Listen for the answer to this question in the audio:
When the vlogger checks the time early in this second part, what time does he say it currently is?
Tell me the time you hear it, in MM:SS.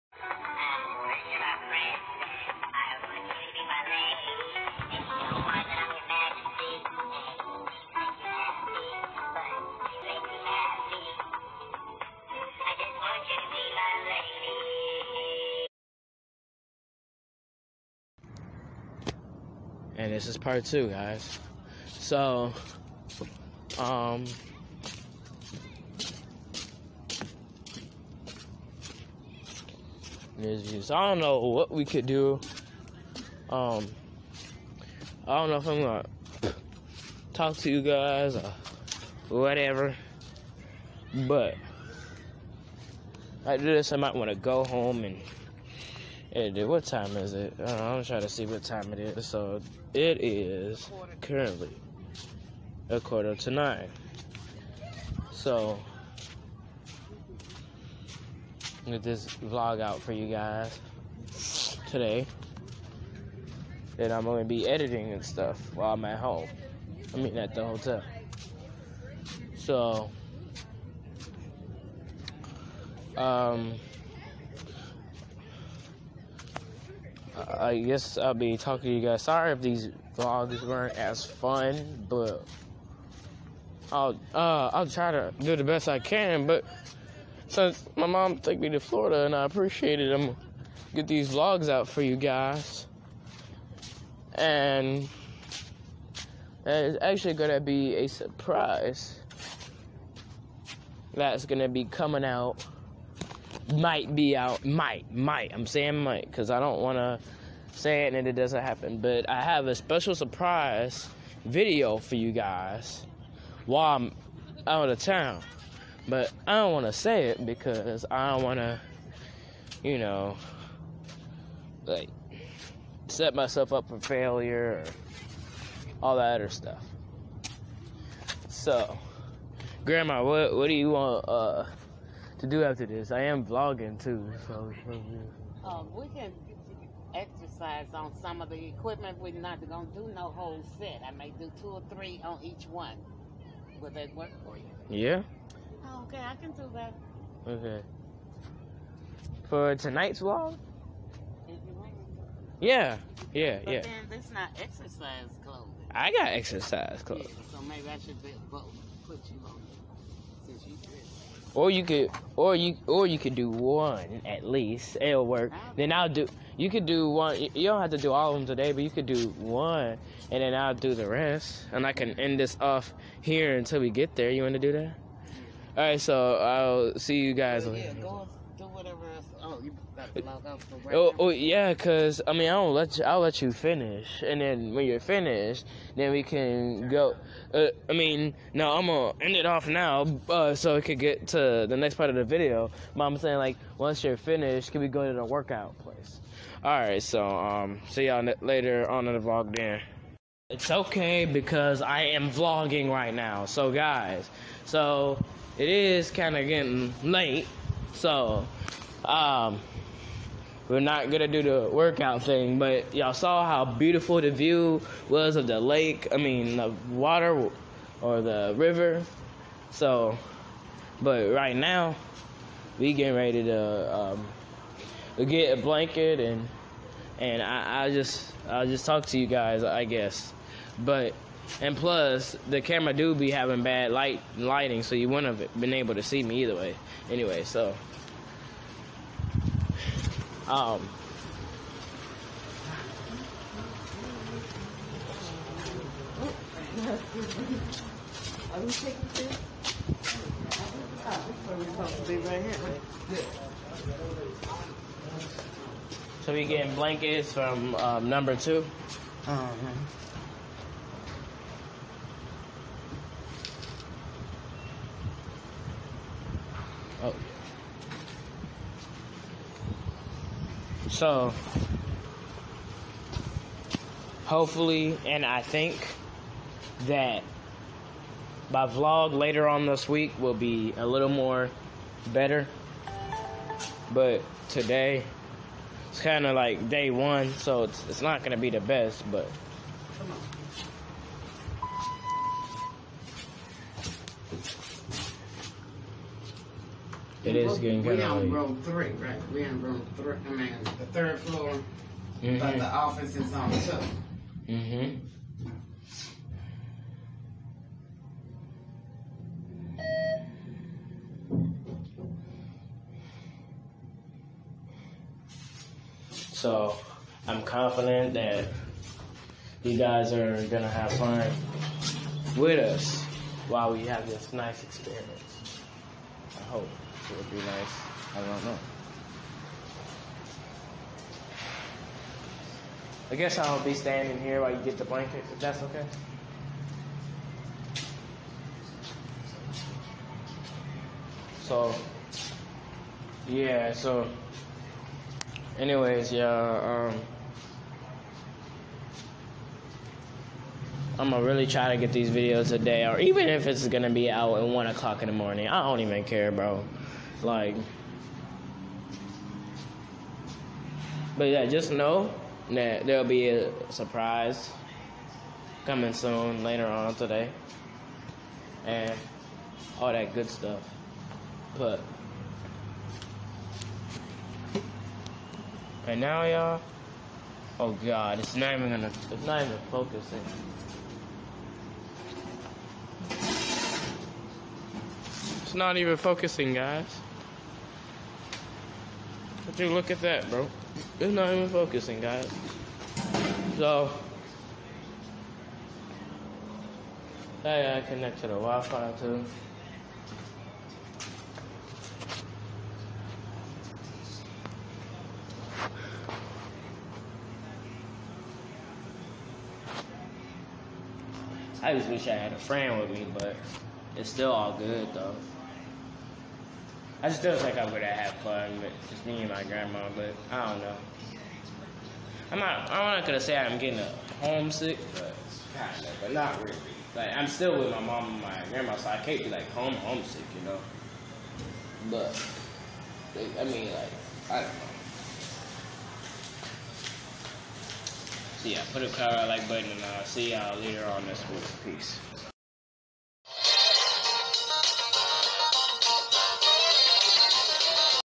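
00:52.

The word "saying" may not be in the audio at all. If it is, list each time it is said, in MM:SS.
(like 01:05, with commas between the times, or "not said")
01:45, 03:13.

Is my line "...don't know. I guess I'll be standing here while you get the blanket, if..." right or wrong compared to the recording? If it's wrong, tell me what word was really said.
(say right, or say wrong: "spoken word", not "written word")
right.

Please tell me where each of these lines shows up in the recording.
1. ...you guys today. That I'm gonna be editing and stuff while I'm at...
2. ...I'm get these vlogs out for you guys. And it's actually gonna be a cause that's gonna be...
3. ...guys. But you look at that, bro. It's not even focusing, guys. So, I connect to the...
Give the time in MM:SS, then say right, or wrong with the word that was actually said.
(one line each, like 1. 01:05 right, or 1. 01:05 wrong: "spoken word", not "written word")
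1. 01:00 right
2. 01:30 wrong: "surprise", not "cause"
3. 06:26 right.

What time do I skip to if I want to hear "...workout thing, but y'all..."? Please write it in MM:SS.
03:31.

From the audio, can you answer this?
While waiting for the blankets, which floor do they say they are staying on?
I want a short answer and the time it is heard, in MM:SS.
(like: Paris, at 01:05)
third floor, at 05:00.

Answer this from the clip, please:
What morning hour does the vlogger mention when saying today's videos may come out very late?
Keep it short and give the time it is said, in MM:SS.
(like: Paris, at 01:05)
1, at 05:54.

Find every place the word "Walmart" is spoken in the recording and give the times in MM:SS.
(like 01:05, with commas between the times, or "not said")
not said.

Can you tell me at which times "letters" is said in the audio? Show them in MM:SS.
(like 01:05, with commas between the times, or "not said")
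not said.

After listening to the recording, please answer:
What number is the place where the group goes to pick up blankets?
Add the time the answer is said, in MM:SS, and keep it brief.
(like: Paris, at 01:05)
2, at 04:18.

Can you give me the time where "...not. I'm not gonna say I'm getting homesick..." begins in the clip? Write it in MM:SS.
07:02.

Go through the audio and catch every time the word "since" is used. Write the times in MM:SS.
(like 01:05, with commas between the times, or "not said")
01:27, 02:40.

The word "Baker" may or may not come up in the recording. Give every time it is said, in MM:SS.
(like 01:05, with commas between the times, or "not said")
not said.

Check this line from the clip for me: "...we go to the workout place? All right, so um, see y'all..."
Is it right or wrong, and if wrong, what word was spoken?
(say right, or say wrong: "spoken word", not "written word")
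right.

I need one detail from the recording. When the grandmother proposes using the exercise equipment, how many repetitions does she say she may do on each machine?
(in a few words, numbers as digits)
two or three.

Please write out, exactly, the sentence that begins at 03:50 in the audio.
But and plus, the camera do be having bad light lighting, so you wouldn't have been able to see me either way.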